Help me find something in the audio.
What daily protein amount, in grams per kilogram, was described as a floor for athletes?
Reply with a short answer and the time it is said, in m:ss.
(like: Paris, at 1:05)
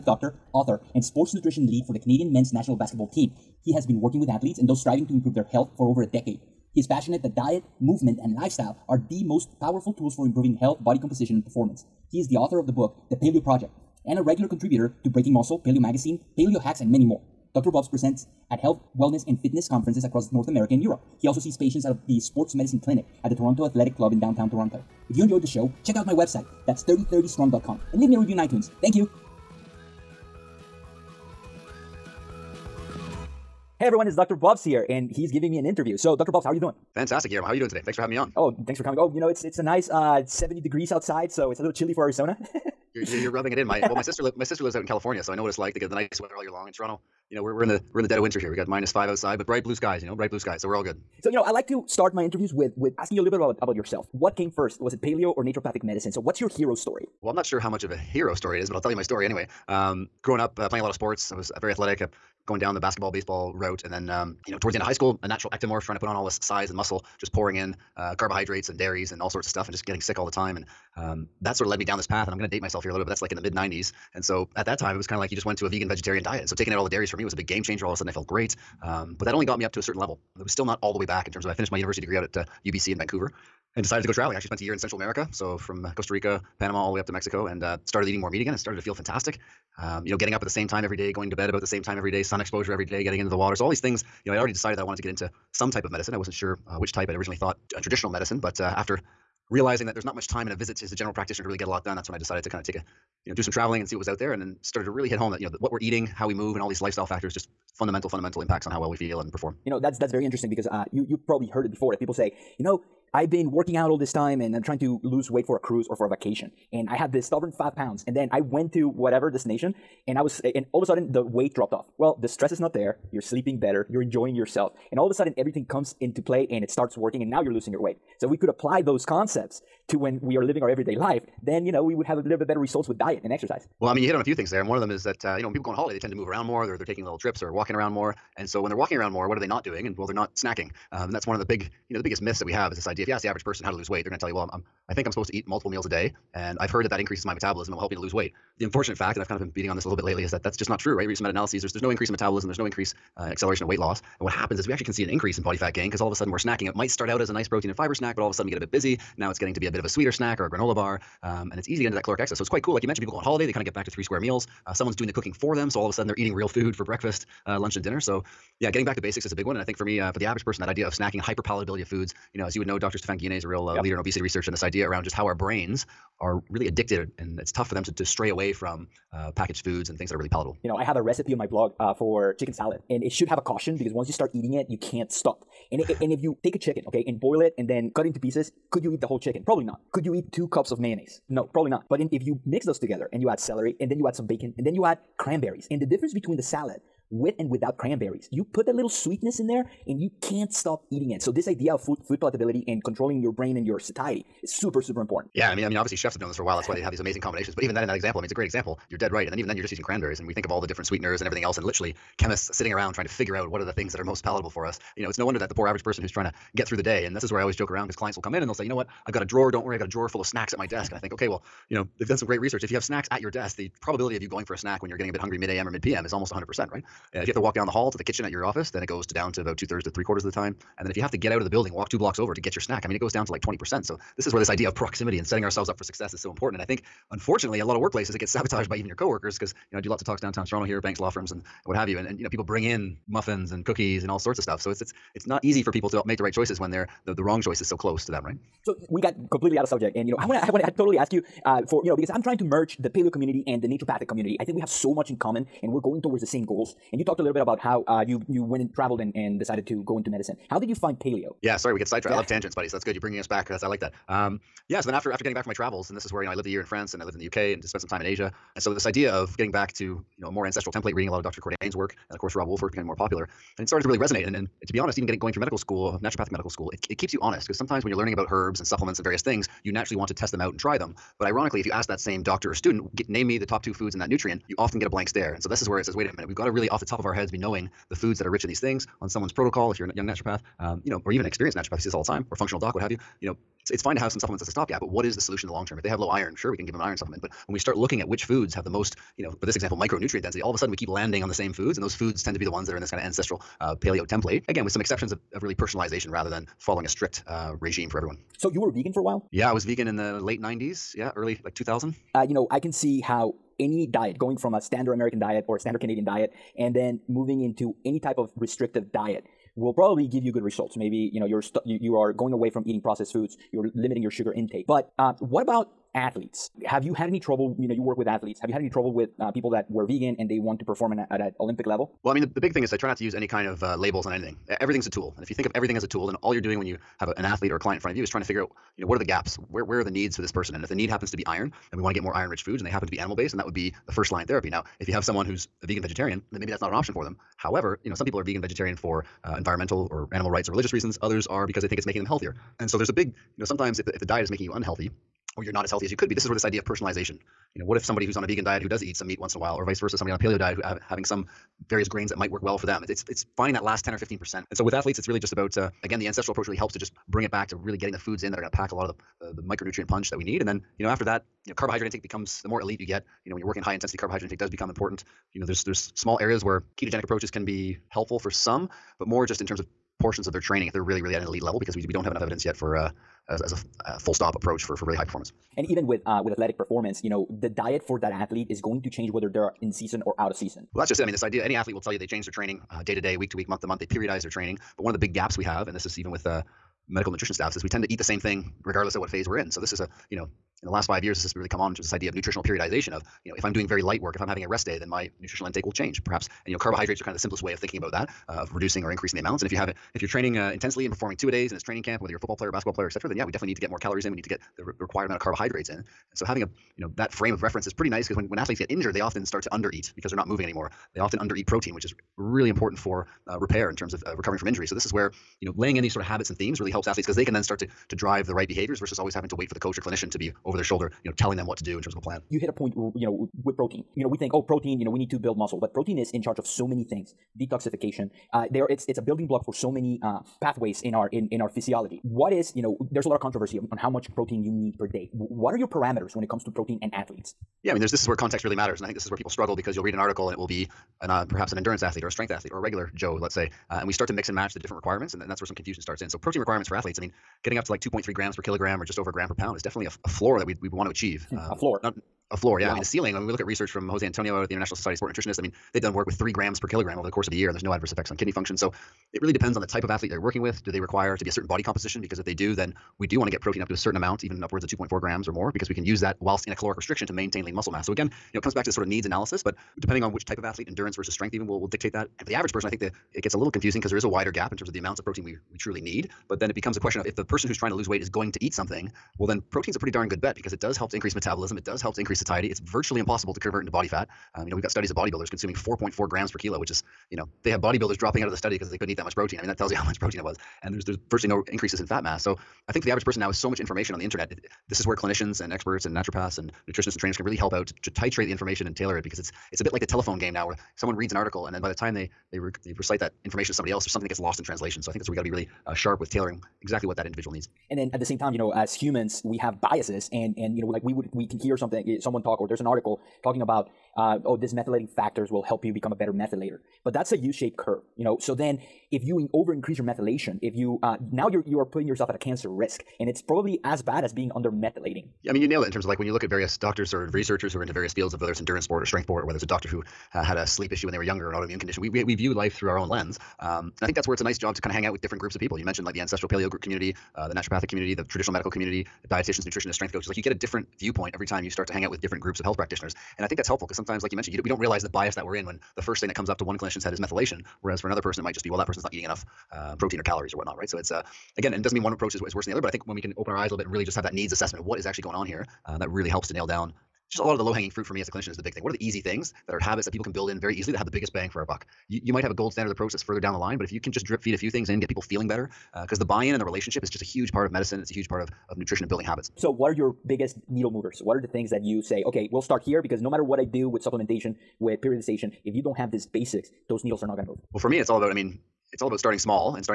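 2.3 grams per kilogram, at 7:37.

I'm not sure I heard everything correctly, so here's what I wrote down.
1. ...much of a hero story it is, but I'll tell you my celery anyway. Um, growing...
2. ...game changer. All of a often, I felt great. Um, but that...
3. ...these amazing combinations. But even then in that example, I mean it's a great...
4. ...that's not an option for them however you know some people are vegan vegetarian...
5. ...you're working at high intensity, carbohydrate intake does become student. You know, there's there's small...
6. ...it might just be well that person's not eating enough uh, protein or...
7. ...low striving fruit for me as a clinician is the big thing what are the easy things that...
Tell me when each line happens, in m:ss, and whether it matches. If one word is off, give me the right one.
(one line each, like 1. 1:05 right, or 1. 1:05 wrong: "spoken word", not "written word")
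1. 0:57 wrong: "story", not "celery"
2. 1:17 wrong: "sudden", not "often"
3. 3:26 right
4. 5:46 right
5. 6:13 wrong: "important", not "student"
6. 9:18 right
7. 9:27 wrong: "hanging", not "striving".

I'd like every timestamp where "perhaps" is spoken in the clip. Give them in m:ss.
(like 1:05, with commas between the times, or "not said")
6:46, 7:31.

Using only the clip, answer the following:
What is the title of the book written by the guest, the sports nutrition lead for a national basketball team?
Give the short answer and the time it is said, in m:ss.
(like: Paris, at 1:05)
The Paleo Project, at 0:13.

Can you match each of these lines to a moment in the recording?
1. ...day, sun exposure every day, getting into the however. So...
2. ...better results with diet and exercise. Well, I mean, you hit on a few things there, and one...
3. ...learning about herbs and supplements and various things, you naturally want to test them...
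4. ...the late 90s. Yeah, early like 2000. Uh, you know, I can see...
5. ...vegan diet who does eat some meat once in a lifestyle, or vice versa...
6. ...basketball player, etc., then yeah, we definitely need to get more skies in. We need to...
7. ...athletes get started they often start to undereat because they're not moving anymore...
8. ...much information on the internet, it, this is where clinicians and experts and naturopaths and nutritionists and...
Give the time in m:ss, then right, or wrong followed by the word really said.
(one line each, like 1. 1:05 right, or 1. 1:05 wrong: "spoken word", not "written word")
1. 1:32 wrong: "water", not "however"
2. 2:12 right
3. 4:37 right
4. 5:09 right
5. 5:58 wrong: "while", not "lifestyle"
6. 6:52 wrong: "calories", not "skies"
7. 6:58 wrong: "injured", not "started"
8. 8:23 right.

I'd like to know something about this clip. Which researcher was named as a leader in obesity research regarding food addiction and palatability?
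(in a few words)
Stephan Guyenet.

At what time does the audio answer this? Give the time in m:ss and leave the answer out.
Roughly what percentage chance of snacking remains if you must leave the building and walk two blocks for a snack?
3:53.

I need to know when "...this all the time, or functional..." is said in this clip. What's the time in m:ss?
4:51.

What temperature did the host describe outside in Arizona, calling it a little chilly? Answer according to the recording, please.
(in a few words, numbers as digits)
70 degrees.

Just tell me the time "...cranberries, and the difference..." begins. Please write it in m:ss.
3:15.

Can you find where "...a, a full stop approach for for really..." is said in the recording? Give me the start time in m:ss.
6:23.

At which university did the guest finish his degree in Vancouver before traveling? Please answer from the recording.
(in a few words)
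UBC.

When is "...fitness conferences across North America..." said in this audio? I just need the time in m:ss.
0:19.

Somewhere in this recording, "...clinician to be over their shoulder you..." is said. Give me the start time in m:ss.
7:09.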